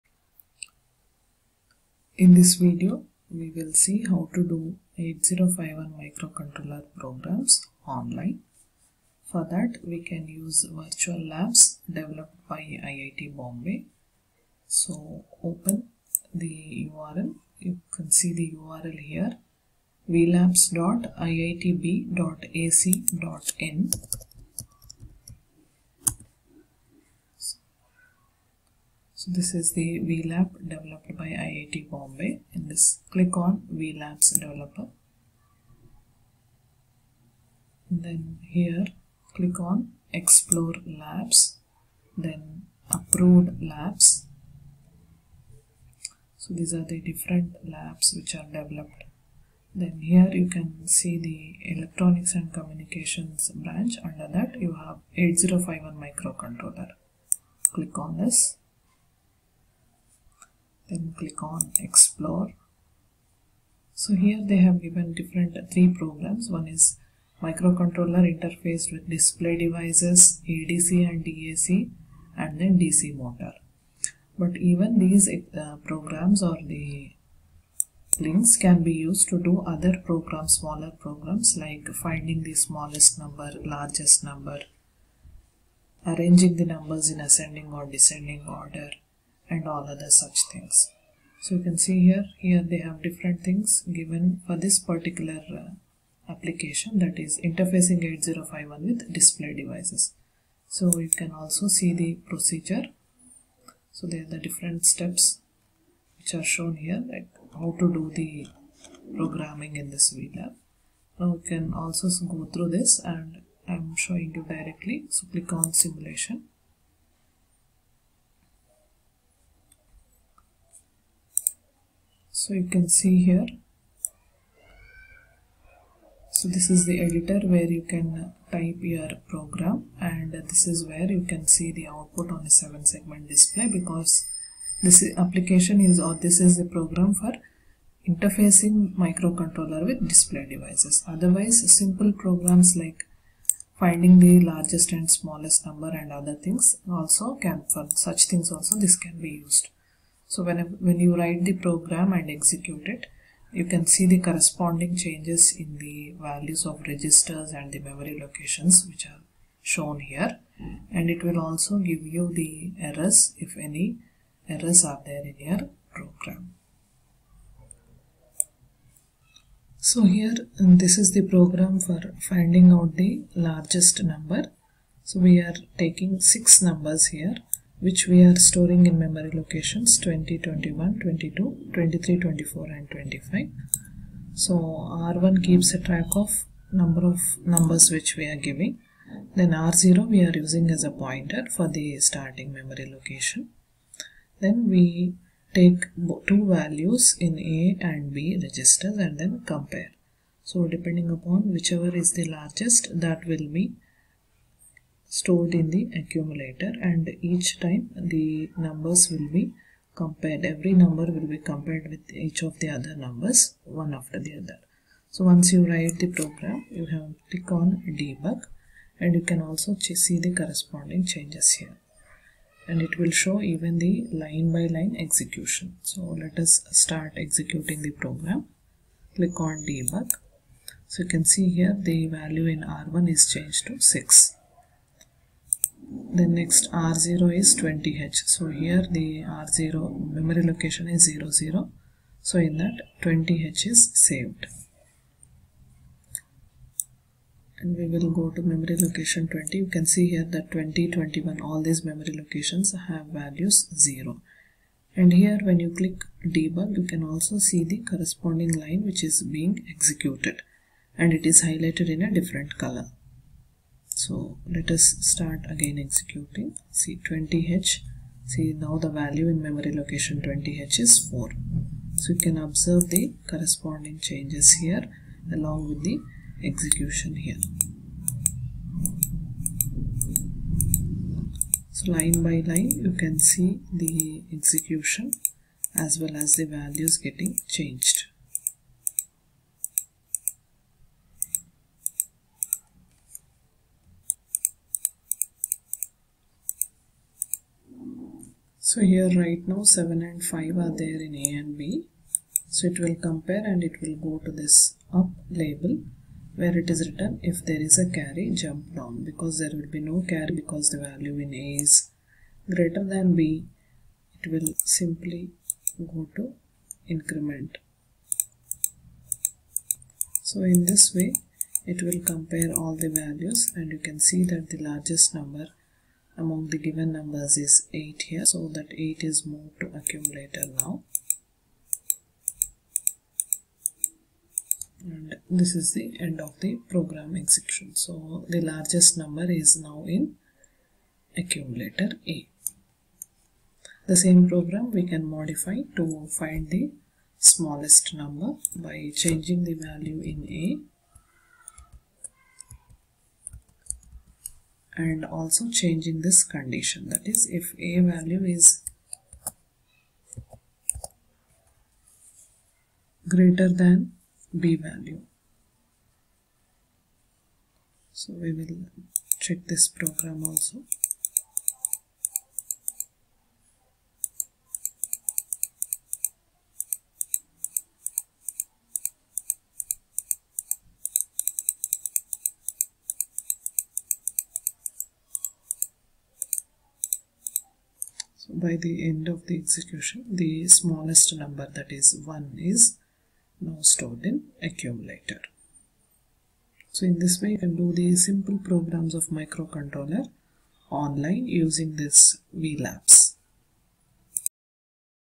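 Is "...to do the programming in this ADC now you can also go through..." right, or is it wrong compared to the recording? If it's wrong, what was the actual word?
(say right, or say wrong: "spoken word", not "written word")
wrong: "VLAB", not "ADC".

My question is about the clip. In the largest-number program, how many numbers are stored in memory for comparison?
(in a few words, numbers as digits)
6.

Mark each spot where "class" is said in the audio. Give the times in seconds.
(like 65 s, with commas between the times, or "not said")
not said.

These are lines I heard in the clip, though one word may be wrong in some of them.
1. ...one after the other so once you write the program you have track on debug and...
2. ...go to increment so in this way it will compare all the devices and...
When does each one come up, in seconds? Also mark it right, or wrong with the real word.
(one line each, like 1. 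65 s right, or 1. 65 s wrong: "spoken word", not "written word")
1. 213 s wrong: "click", not "track"
2. 315 s wrong: "values", not "devices".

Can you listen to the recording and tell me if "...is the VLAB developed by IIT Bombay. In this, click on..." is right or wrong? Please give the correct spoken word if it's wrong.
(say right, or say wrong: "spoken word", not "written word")
right.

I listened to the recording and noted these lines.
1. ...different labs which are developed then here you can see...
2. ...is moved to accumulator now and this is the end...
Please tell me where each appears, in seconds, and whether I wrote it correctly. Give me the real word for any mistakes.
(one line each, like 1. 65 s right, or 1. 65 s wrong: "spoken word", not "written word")
1. 46 s right
2. 329 s right.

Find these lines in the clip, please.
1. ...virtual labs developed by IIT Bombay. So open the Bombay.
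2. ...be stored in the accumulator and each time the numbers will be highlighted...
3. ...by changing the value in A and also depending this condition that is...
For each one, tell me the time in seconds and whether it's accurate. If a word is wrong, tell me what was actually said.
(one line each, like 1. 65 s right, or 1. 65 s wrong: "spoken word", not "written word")
1. 10 s wrong: "URL", not "Bombay"
2. 203 s wrong: "compared", not "highlighted"
3. 348 s wrong: "changing", not "depending".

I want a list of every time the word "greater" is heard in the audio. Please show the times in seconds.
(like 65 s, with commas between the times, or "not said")
312 s, 363 s.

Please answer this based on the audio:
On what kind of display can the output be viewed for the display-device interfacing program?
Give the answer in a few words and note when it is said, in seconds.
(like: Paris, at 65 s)
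7 segment display, at 132 s.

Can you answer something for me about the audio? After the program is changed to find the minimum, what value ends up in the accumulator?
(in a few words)
1.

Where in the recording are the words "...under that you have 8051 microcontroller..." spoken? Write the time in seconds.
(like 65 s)
54 s.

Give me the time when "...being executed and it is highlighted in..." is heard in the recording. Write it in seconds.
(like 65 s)
259 s.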